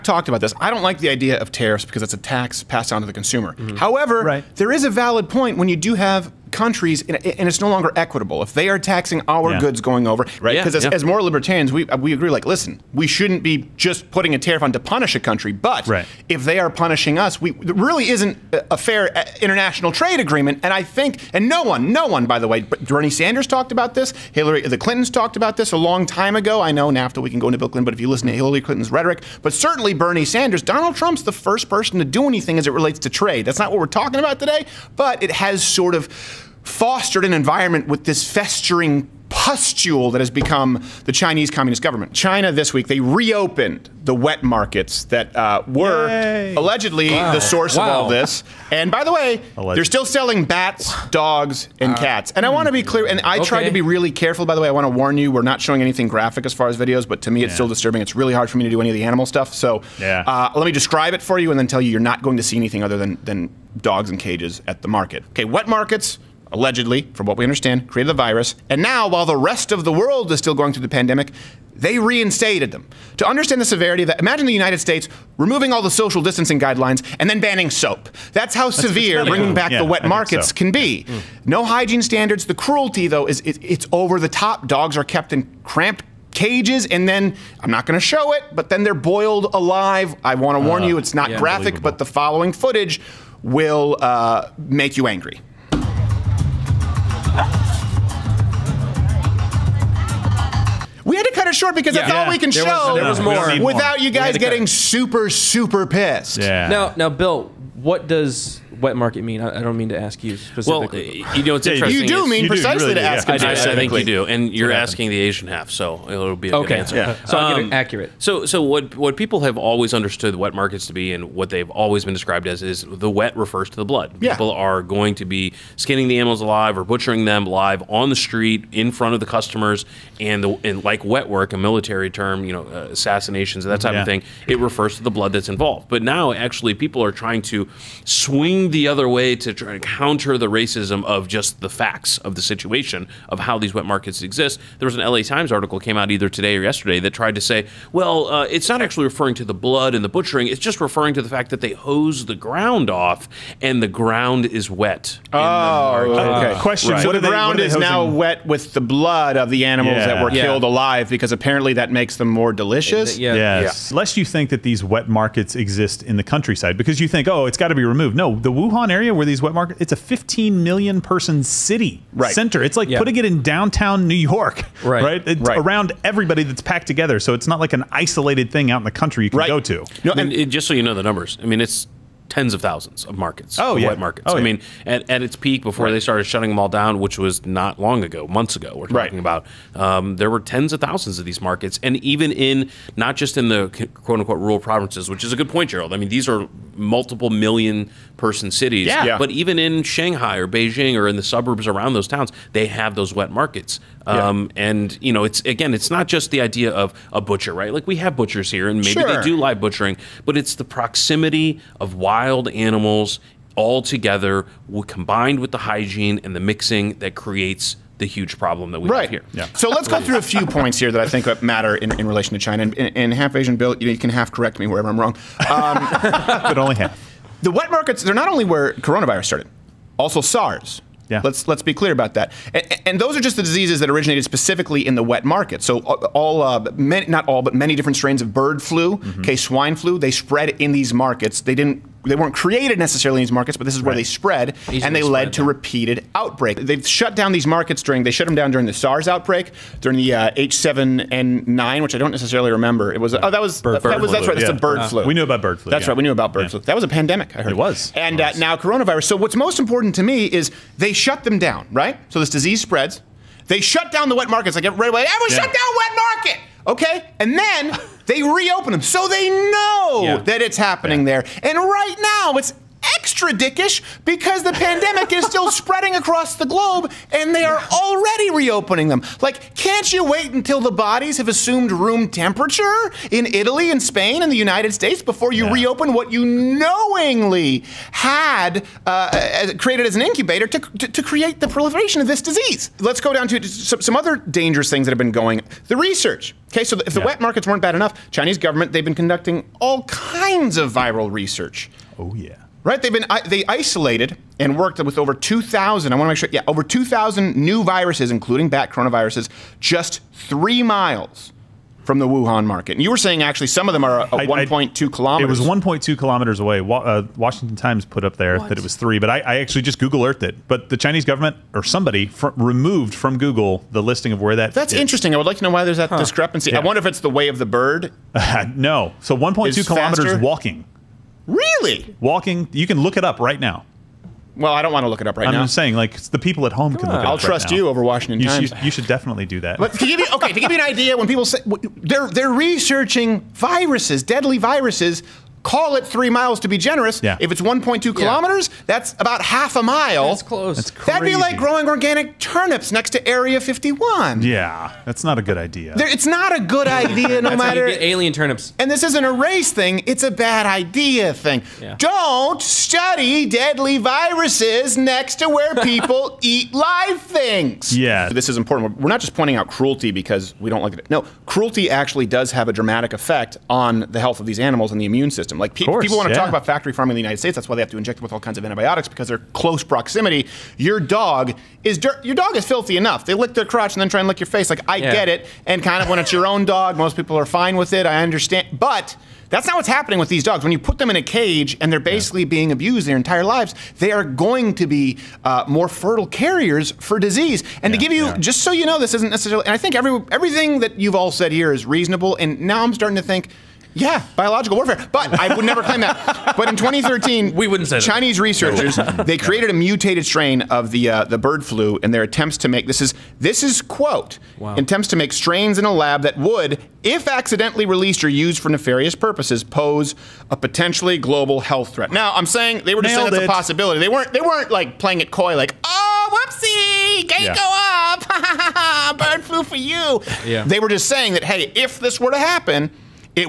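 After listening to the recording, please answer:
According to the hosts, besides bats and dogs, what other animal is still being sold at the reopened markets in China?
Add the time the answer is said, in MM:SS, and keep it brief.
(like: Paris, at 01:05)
Cats, at 00:51.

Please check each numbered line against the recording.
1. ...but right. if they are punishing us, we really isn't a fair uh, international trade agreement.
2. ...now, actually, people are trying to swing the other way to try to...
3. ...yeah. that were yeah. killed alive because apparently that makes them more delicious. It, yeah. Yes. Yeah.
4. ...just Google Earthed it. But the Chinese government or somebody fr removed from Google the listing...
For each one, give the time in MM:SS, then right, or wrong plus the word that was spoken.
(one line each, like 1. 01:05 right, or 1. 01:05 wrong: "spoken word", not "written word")
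1. 00:15 right
2. 02:16 right
3. 02:39 right
4. 05:19 right.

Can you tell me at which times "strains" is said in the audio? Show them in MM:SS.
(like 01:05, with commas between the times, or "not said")
03:57, 06:50, 06:55.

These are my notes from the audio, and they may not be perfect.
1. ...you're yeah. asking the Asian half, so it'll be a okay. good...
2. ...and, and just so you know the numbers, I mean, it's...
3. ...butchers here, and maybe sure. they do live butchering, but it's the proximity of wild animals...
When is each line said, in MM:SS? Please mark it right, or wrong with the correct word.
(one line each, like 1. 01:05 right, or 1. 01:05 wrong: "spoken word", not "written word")
1. 01:54 right
2. 03:00 right
3. 03:28 right.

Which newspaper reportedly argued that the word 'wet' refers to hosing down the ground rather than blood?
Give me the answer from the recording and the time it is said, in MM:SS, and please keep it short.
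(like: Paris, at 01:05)
LA Times, at 02:25.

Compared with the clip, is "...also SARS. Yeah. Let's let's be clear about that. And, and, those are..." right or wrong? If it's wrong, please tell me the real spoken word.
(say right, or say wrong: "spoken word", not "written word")
right.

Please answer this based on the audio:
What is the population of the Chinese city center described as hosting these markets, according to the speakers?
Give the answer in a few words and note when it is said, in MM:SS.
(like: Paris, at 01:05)
15 million, at 02:49.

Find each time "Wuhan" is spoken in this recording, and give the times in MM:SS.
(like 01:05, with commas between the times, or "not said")
02:48, 05:12.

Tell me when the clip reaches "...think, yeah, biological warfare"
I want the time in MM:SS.
06:43.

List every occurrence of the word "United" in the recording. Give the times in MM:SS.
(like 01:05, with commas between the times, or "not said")
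01:14, 04:44, 06:17.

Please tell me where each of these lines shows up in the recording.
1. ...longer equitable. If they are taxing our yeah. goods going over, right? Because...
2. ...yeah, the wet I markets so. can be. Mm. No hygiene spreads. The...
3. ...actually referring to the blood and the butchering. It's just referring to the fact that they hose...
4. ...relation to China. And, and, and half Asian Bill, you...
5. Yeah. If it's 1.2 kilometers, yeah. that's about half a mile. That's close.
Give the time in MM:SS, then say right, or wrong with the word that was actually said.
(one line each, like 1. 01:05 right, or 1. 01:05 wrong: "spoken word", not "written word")
1. 00:07 right
2. 01:19 wrong: "standards", not "spreads"
3. 02:28 right
4. 03:42 right
5. 05:47 right.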